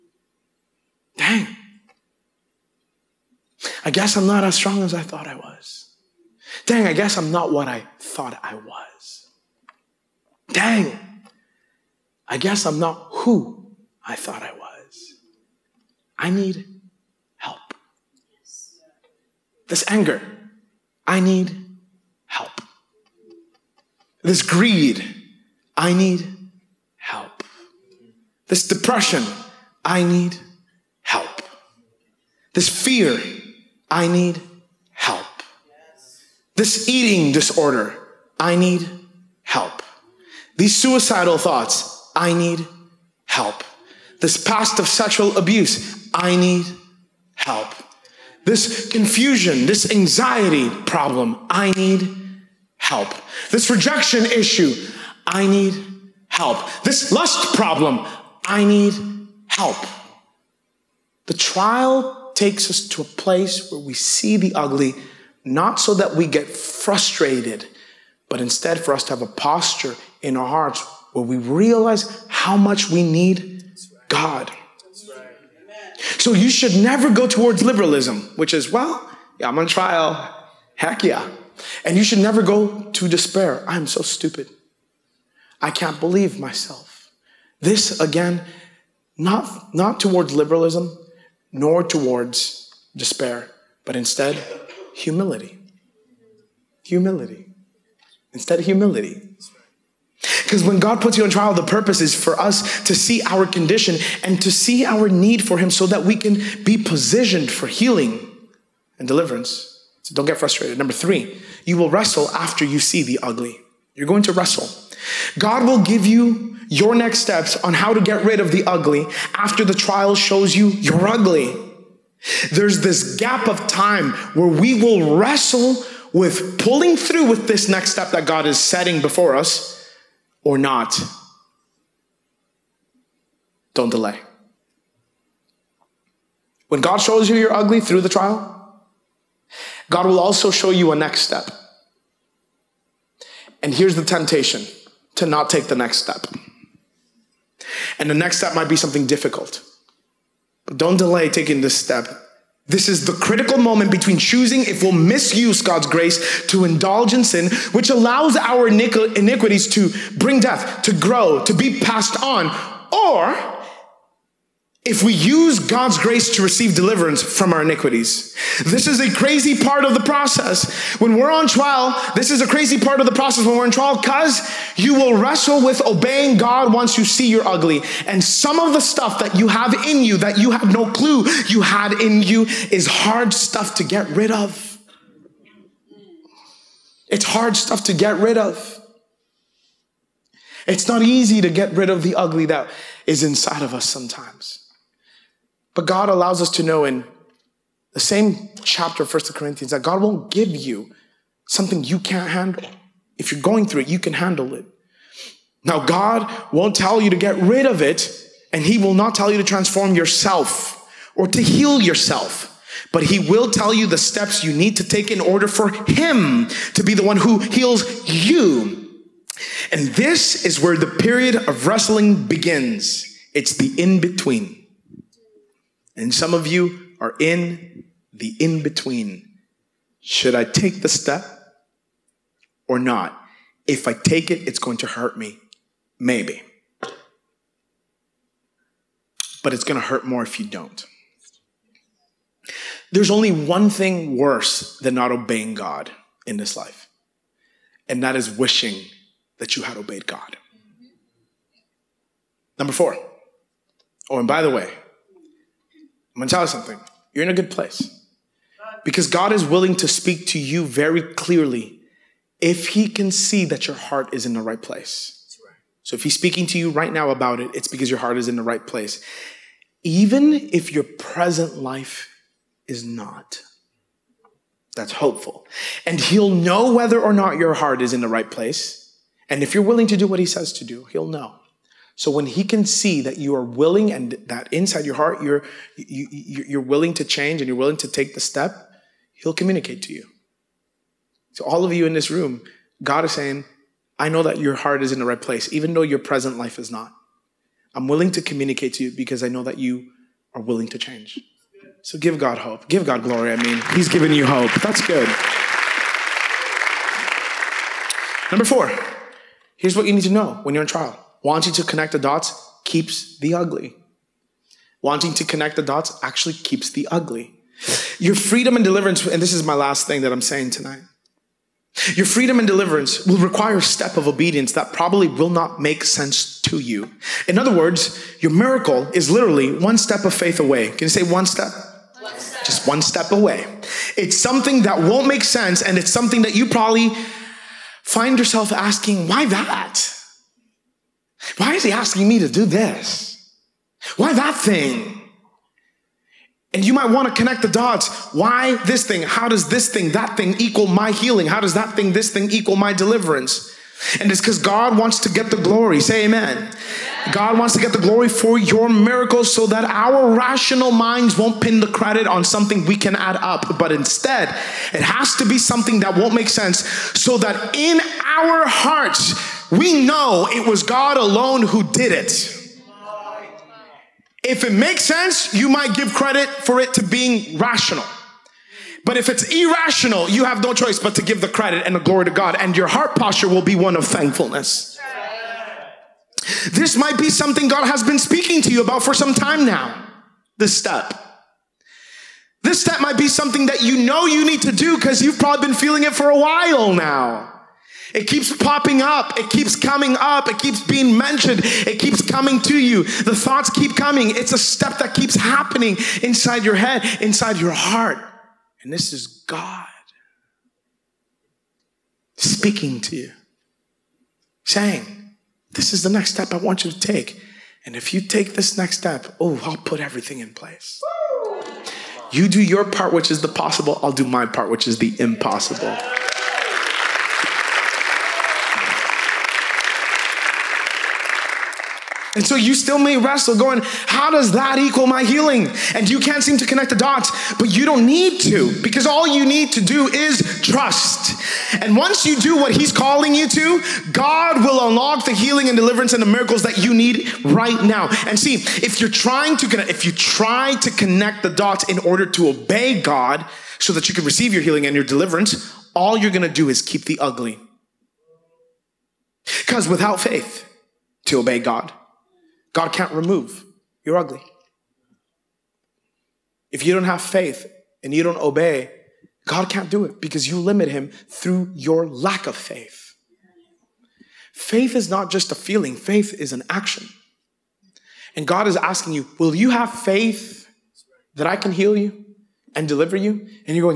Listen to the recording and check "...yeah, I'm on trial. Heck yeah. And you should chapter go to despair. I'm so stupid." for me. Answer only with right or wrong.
wrong.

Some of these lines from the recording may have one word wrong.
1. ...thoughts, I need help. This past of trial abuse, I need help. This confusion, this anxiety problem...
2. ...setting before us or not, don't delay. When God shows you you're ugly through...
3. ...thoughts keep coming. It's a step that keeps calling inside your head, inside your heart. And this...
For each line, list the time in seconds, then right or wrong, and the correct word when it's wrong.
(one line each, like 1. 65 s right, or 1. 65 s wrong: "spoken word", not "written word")
1. 41 s wrong: "sexual", not "trial"
2. 128 s right
3. 403 s wrong: "happening", not "calling".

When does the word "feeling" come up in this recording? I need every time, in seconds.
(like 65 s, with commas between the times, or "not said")
395 s, 475 s.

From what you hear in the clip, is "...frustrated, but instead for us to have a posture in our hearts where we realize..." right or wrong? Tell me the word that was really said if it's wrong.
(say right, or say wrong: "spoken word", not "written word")
right.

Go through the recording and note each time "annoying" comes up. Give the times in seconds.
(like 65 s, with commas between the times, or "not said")
not said.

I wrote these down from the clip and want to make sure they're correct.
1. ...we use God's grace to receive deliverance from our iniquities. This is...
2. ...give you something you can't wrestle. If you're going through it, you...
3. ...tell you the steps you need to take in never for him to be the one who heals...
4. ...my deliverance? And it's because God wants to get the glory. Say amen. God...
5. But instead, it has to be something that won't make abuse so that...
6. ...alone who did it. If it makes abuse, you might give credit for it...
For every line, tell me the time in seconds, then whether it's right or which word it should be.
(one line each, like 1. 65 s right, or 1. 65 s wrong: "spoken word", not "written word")
1. 165 s right
2. 200 s wrong: "handle", not "wrestle"
3. 213 s wrong: "order", not "never"
4. 352 s right
5. 363 s wrong: "sense", not "abuse"
6. 370 s wrong: "sense", not "abuse".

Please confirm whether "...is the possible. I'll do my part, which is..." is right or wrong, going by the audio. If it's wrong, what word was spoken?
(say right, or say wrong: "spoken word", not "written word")
right.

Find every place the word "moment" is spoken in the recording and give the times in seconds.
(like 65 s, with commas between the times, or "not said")
153 s.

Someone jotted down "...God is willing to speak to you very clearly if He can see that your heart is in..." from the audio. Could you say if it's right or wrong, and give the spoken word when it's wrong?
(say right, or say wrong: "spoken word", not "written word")
right.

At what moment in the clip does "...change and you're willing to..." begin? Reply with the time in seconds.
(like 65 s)
287 s.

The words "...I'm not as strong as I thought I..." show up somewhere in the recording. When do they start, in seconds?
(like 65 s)
4 s.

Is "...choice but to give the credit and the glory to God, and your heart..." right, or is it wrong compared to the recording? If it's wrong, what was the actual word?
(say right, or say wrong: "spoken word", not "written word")
right.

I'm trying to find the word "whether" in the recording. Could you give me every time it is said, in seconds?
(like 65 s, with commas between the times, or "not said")
276 s.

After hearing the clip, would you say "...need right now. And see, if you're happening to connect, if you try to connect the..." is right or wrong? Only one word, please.
wrong.